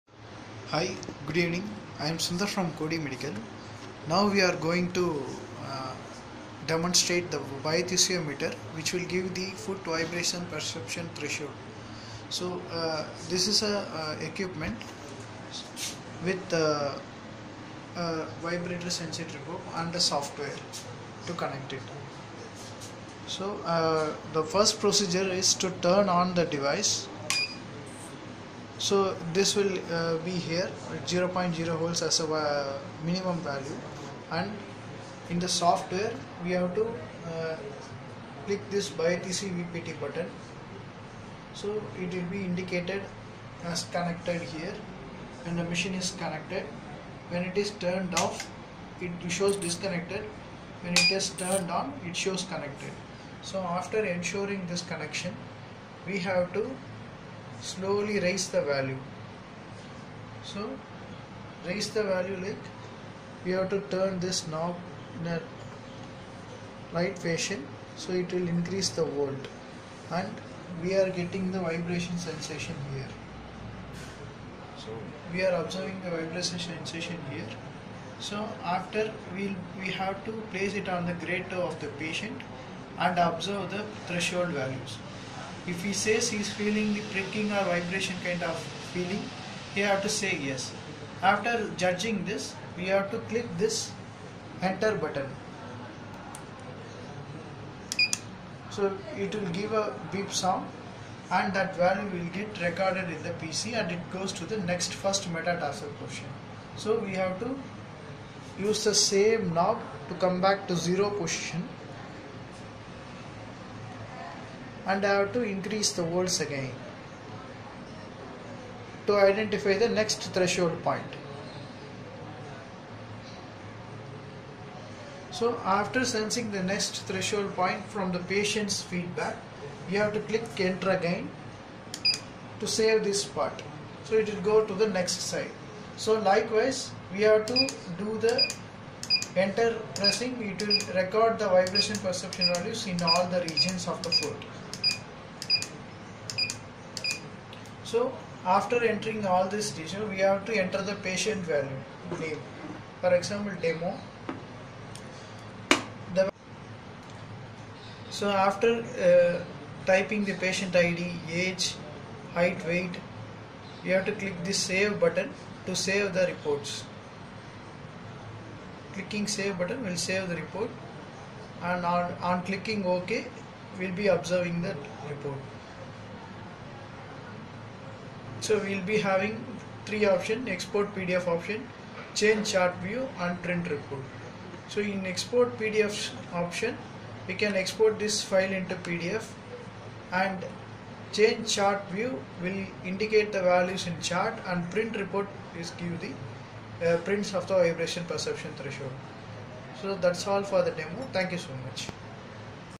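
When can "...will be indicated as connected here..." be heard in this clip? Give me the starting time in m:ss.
0:42.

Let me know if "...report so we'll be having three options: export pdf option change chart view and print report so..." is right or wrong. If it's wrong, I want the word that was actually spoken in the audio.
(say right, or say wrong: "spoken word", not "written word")
right.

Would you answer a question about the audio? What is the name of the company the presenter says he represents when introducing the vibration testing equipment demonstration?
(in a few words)
Kody Medical.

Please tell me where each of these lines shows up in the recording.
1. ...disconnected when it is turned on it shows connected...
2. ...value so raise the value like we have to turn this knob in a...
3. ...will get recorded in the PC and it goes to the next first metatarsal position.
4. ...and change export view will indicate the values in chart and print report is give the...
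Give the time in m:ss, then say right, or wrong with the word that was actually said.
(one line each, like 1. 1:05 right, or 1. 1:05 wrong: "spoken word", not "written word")
1. 0:49 right
2. 0:58 right
3. 1:42 right
4. 3:10 wrong: "chart", not "export".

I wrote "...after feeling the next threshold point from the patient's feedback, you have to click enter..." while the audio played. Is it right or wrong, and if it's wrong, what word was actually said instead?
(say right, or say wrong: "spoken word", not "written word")
wrong: "sensing", not "feeling".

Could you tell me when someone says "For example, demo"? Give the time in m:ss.
2:33.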